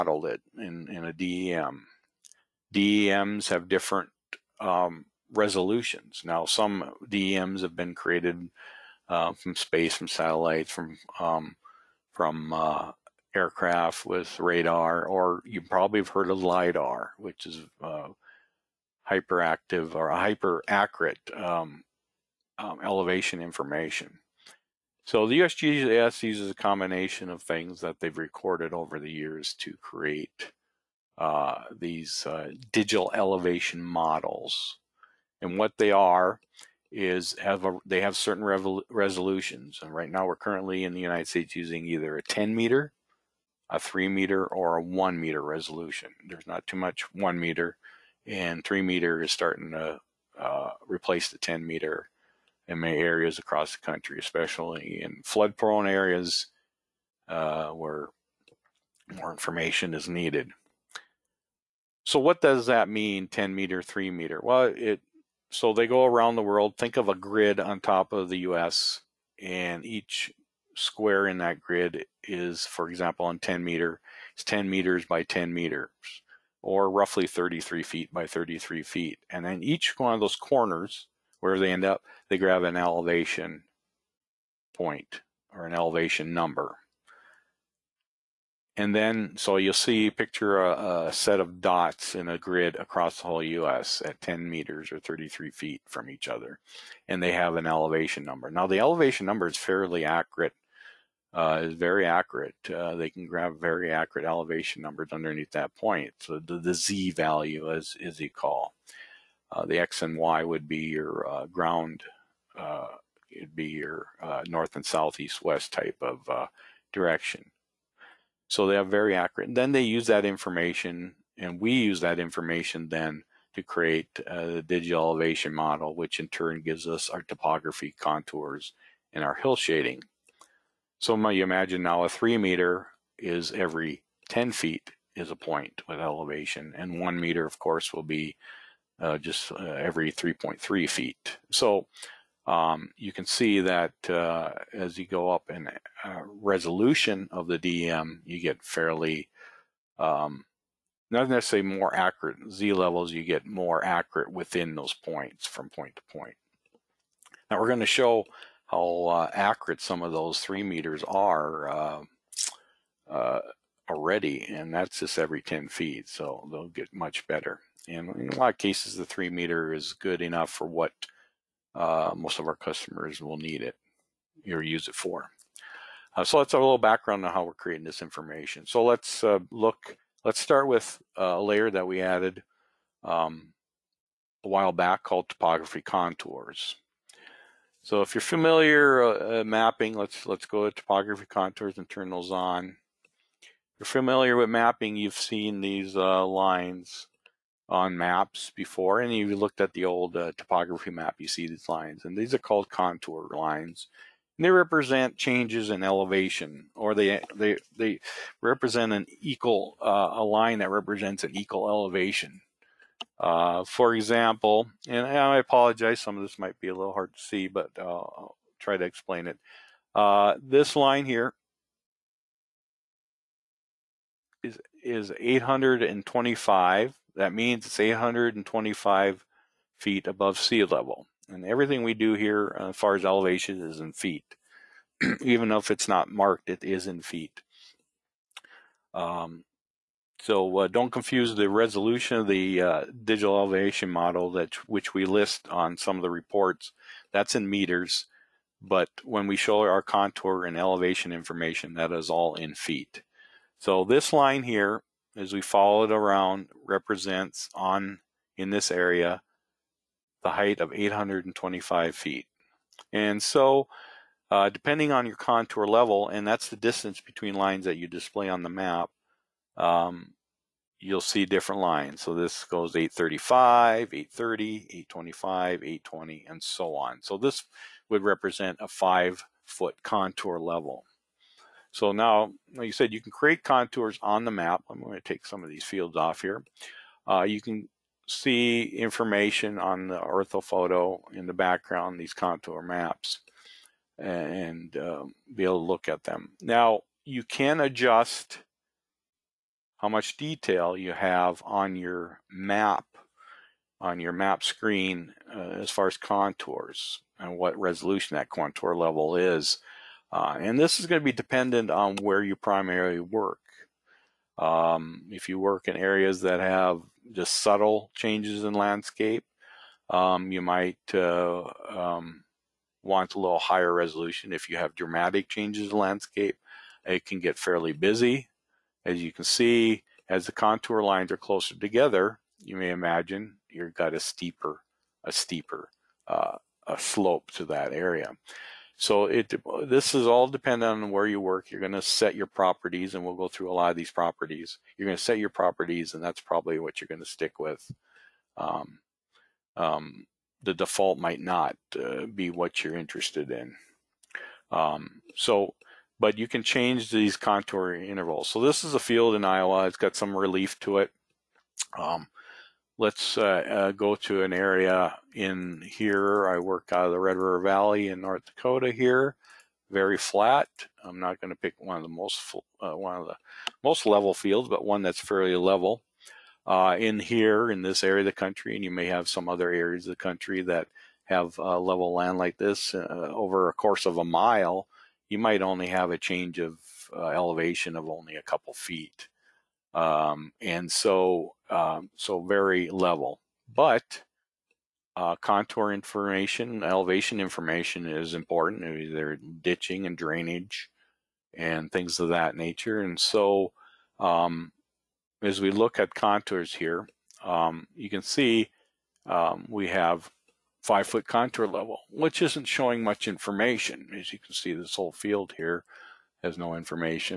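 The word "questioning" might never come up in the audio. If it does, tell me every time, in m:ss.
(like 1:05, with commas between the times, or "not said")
not said.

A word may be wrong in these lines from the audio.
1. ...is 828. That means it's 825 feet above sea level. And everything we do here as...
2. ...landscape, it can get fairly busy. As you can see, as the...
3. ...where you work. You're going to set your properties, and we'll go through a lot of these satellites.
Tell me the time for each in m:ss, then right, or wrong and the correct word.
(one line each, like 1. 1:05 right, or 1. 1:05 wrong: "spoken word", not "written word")
1. 3:44 wrong: "825", not "828"
2. 5:25 right
3. 5:40 wrong: "properties", not "satellites".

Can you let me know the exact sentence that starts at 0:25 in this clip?
So the USGS uses a combination of things that they've recorded over the years to create uh, these uh, digital elevation models.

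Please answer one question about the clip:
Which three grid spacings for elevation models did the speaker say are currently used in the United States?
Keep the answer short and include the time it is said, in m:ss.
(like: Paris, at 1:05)
10, 3, or 1 meter, at 0:42.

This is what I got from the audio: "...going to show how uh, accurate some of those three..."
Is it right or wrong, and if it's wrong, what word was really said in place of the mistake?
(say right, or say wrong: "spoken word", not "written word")
right.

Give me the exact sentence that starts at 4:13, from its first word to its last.
So this line here, as we follow it around, represents on in this area the height of 825 feet.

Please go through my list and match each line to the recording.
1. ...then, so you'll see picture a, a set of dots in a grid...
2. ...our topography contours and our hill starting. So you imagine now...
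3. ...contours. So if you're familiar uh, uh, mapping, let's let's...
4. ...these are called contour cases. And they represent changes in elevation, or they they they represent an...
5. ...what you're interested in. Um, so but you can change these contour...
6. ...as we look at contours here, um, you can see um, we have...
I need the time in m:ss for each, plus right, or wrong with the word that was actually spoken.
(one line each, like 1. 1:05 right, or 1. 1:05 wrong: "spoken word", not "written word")
1. 1:28 right
2. 2:07 wrong: "shading", not "starting"
3. 3:05 right
4. 3:22 wrong: "lines", not "cases"
5. 5:52 right
6. 6:45 right.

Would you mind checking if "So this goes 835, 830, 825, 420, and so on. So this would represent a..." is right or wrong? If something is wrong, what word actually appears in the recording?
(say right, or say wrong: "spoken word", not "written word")
wrong: "820", not "420".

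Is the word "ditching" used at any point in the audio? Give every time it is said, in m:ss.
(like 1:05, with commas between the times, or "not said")
6:39.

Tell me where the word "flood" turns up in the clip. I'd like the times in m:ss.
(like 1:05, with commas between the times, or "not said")
0:55.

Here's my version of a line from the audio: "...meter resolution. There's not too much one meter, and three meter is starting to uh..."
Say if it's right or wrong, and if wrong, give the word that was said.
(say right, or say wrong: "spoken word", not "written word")
right.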